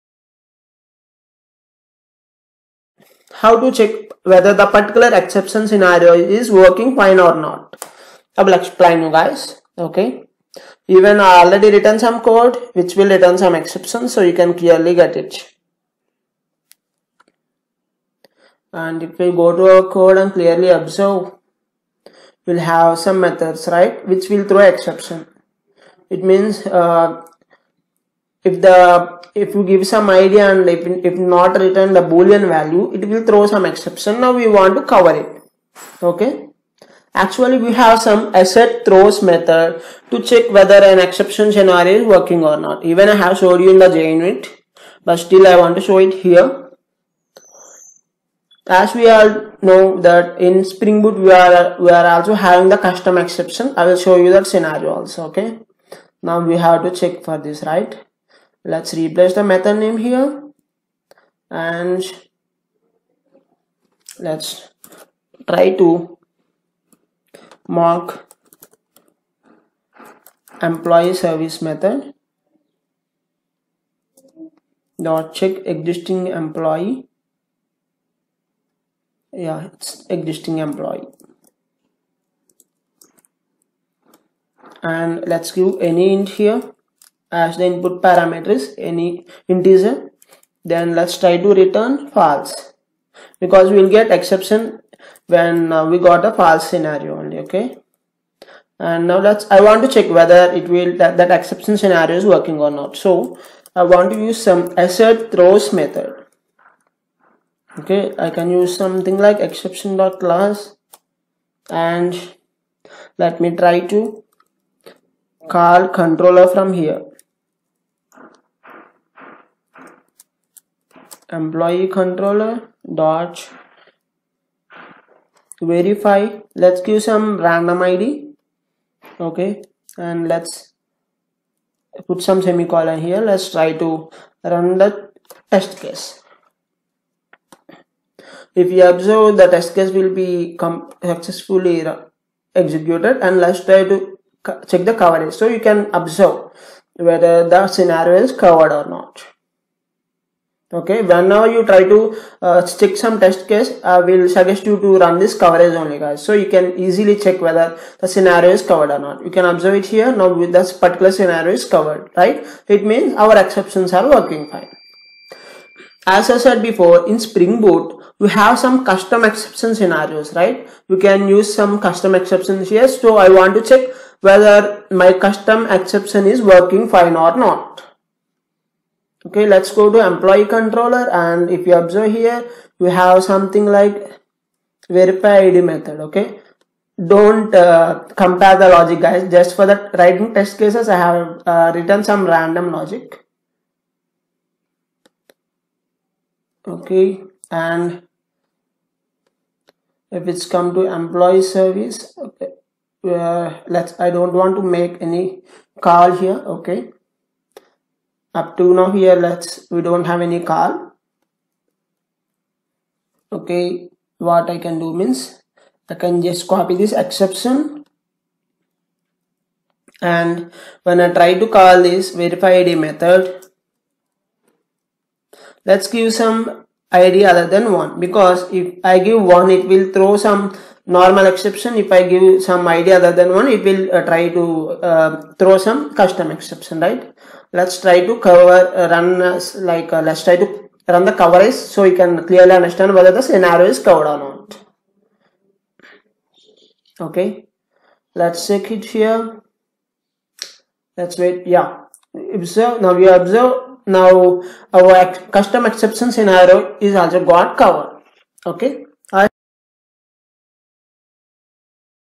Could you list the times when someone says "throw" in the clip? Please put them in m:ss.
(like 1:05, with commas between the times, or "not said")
0:24, 0:33, 0:38, 1:45, 3:49, 3:55.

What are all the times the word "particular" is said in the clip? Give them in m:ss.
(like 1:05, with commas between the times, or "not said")
0:04, 2:40.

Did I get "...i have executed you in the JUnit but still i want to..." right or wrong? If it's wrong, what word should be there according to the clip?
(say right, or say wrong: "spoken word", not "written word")
wrong: "showed", not "executed".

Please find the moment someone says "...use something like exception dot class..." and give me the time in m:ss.
1:48.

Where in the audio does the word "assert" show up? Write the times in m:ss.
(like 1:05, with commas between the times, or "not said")
0:38, 1:44.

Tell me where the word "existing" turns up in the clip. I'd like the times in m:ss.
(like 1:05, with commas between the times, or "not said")
1:15, 1:20.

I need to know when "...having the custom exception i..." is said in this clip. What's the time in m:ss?
0:52.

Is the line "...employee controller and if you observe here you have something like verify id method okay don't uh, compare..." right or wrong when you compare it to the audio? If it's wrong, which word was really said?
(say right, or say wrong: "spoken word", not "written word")
right.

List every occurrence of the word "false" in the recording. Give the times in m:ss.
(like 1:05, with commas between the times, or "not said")
1:32, 1:36.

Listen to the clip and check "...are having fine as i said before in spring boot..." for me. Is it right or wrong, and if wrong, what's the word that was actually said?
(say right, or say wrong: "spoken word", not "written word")
wrong: "working", not "having".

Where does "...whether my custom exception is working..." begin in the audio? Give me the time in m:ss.
2:54.